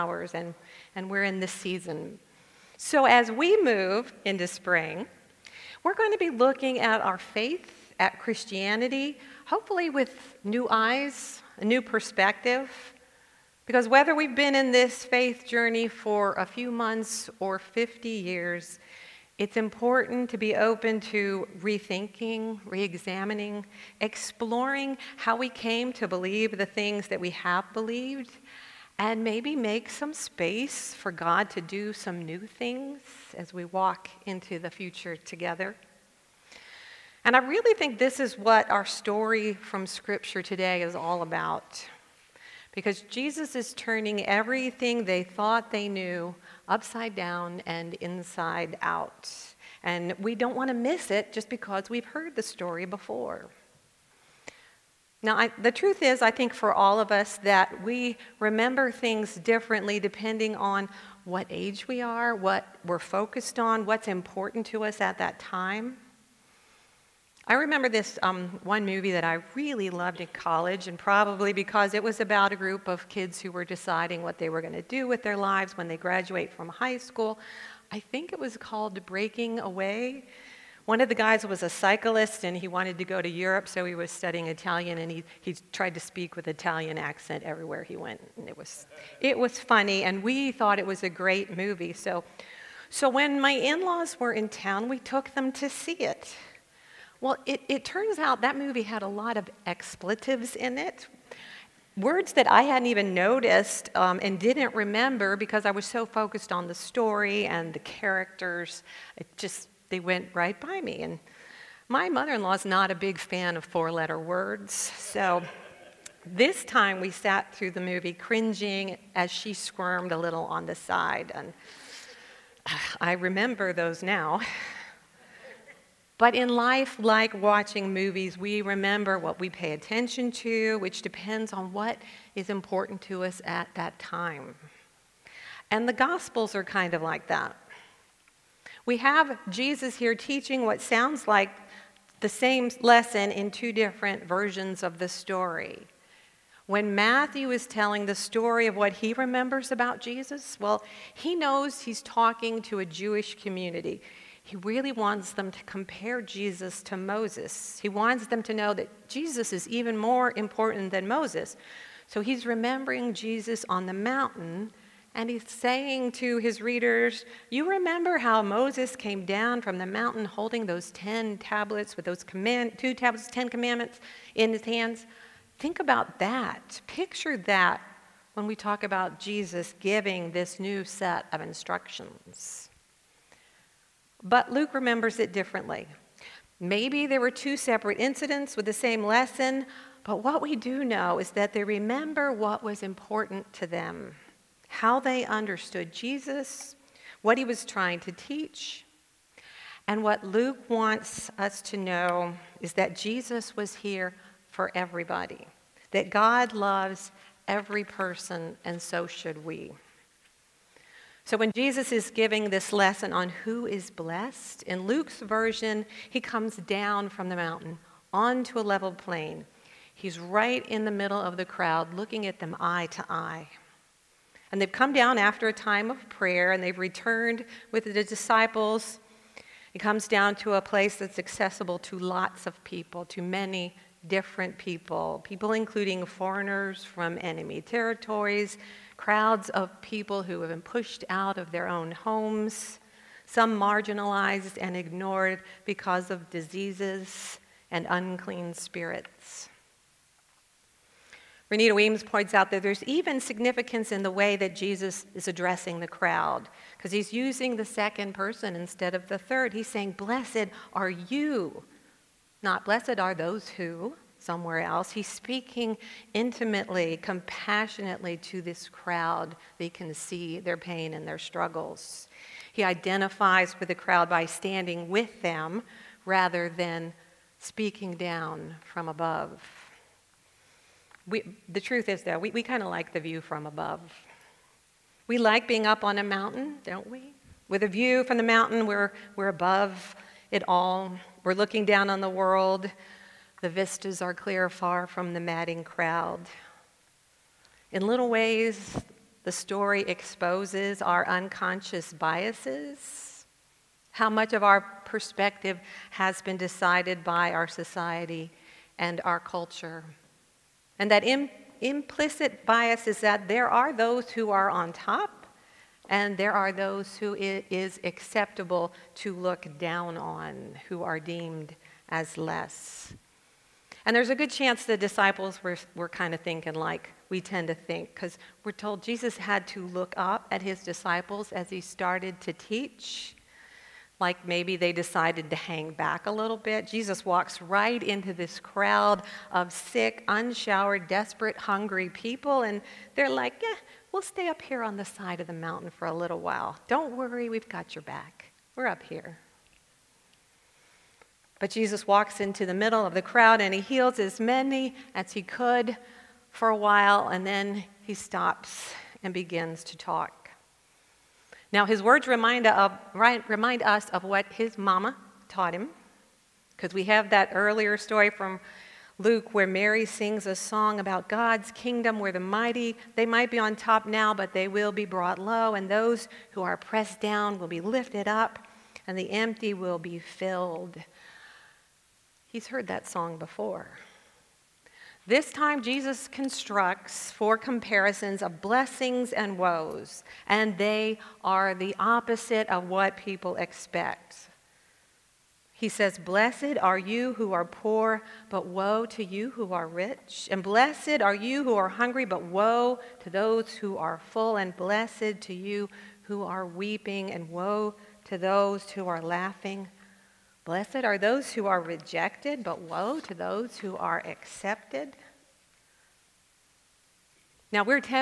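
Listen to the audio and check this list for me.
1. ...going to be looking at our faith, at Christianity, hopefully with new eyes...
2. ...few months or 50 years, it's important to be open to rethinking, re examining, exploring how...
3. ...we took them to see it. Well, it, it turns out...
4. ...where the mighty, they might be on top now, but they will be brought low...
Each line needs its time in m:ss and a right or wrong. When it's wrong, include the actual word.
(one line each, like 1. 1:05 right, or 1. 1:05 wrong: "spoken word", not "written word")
1. 0:05 right
2. 0:16 right
3. 1:34 right
4. 6:11 right.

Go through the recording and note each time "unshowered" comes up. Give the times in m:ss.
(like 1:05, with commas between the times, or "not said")
5:40.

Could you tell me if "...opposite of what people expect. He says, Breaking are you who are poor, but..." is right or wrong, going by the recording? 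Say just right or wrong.
wrong.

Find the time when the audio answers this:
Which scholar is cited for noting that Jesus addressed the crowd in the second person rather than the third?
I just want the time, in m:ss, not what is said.
4:11.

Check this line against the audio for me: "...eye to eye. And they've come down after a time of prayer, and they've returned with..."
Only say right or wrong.
right.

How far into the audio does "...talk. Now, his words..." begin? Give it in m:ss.
5:59.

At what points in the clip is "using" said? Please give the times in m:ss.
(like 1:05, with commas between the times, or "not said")
4:17.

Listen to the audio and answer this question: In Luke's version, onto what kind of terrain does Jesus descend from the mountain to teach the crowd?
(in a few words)
a level plain.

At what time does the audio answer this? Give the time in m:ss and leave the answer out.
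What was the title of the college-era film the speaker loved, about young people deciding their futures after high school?
1:19.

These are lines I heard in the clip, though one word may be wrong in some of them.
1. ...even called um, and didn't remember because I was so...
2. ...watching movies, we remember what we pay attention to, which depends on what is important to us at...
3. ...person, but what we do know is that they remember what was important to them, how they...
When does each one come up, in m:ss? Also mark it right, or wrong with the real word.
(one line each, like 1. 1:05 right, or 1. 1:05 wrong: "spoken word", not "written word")
1. 1:42 wrong: "noticed", not "called"
2. 2:07 right
3. 3:09 wrong: "lesson", not "person".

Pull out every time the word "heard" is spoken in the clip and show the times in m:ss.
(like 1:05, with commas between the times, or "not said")
0:52, 6:22.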